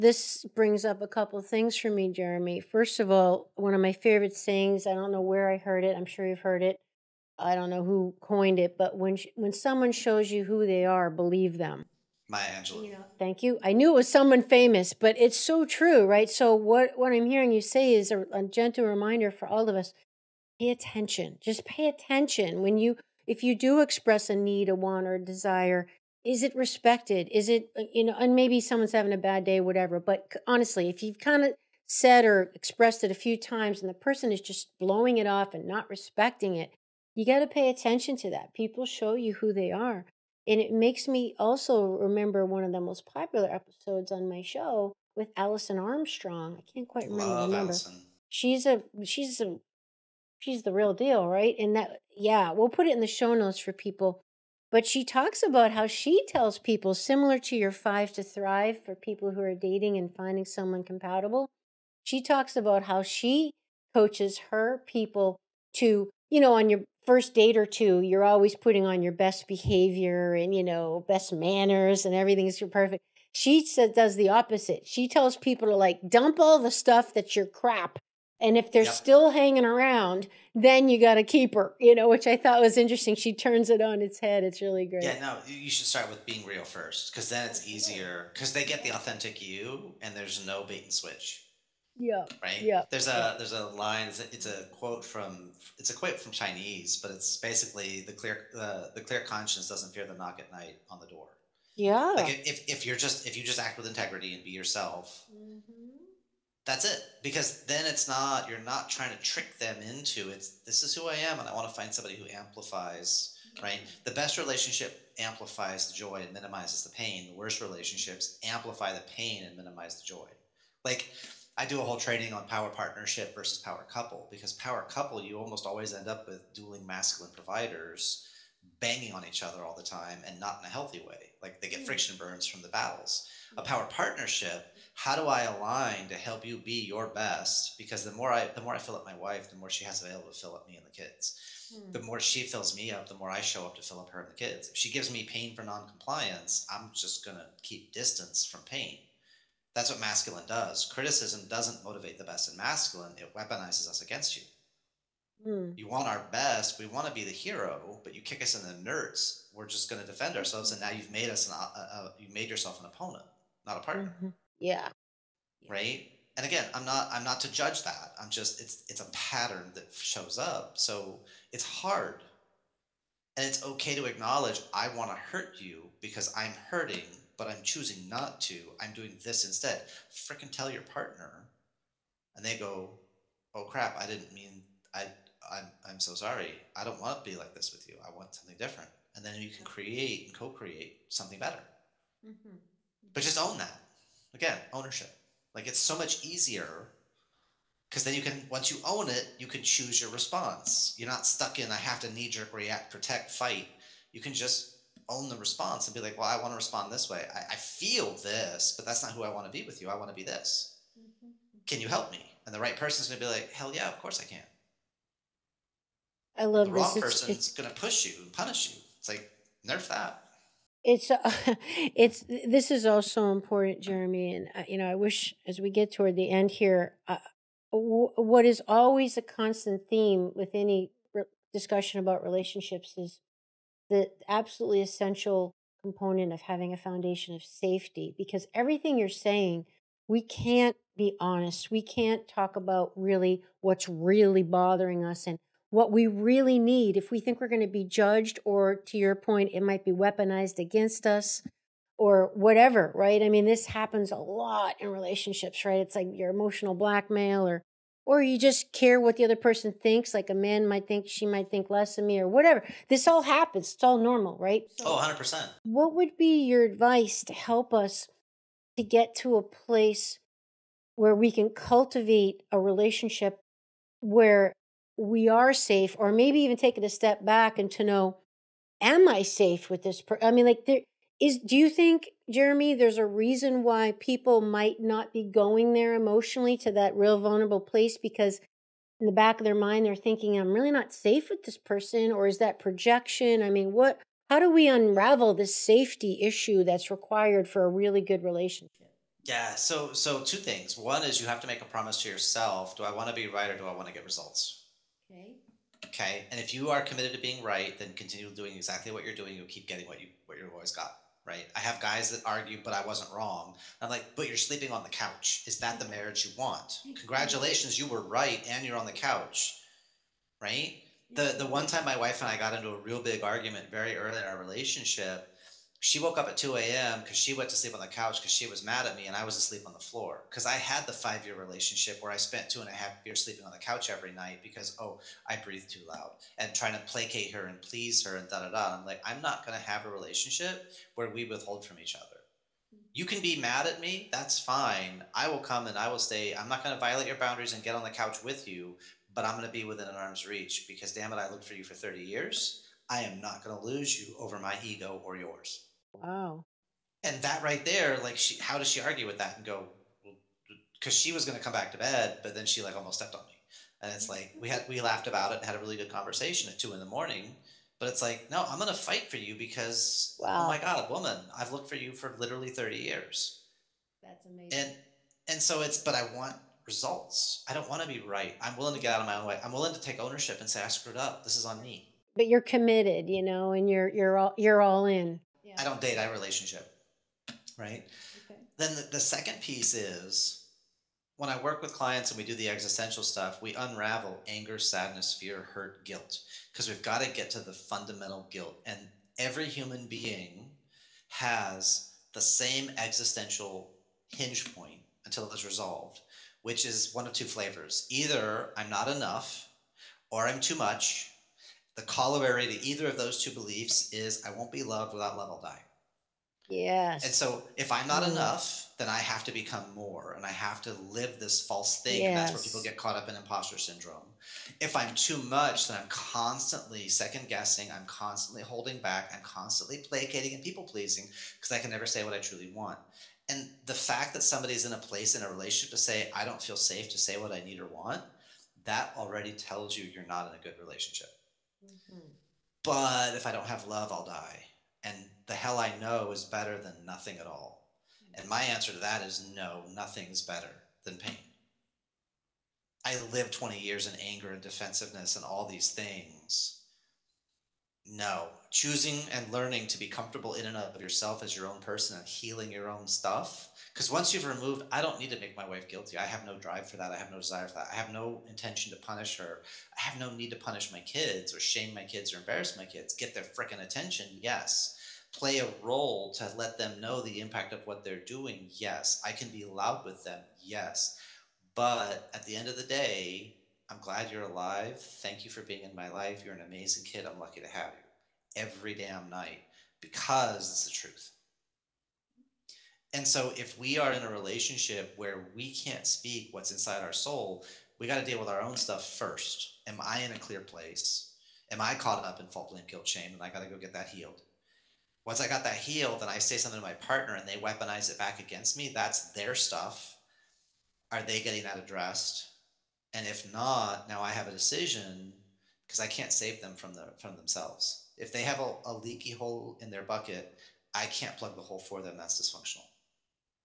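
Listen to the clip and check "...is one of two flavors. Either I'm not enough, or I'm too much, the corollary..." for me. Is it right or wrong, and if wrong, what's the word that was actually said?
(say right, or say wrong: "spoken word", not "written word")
right.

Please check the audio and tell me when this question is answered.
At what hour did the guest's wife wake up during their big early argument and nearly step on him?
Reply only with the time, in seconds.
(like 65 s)
326 s.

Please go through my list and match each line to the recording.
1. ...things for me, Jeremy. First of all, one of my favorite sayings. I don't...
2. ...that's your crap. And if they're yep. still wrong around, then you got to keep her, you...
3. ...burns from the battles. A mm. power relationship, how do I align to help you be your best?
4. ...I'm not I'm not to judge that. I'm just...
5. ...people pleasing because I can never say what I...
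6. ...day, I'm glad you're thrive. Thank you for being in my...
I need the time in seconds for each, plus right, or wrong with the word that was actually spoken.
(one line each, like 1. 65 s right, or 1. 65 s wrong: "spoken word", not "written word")
1. 1 s right
2. 77 s wrong: "hanging", not "wrong"
3. 132 s wrong: "partnership", not "relationship"
4. 166 s right
5. 430 s right
6. 482 s wrong: "alive", not "thrive".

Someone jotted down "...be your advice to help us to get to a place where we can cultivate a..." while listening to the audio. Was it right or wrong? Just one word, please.
right.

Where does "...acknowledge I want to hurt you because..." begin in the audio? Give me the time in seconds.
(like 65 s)
174 s.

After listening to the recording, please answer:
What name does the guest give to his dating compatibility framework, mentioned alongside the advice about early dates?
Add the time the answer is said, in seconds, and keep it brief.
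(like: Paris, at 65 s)
5 to thrive, at 57 s.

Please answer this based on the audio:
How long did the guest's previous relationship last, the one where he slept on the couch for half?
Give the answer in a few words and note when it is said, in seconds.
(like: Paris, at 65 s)
5 years, at 330 s.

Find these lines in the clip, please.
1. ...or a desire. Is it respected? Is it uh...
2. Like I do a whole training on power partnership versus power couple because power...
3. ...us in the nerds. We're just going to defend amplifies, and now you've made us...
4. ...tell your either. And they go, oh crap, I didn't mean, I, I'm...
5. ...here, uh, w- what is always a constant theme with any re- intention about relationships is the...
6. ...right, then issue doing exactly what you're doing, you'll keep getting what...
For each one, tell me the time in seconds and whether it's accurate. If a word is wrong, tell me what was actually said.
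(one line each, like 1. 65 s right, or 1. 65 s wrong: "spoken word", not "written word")
1. 25 s right
2. 120 s right
3. 158 s wrong: "ourselves", not "amplifies"
4. 180 s wrong: "partner", not "either"
5. 226 s wrong: "discussion", not "intention"
6. 307 s wrong: "continue", not "issue".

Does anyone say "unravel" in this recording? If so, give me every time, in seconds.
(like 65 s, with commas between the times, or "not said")
294 s, 393 s.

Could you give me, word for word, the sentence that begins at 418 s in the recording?
enough, then I have to become more and I have to live this false thing.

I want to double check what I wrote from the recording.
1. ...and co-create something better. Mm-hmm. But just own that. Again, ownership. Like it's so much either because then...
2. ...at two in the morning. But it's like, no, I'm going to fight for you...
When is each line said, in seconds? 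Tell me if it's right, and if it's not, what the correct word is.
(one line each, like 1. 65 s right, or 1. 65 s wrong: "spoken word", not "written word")
1. 190 s wrong: "easier", not "either"
2. 366 s right.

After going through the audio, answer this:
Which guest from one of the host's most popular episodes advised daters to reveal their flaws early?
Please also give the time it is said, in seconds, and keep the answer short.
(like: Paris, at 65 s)
Alison Armstrong, at 45 s.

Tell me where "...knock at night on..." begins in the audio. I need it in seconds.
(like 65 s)
100 s.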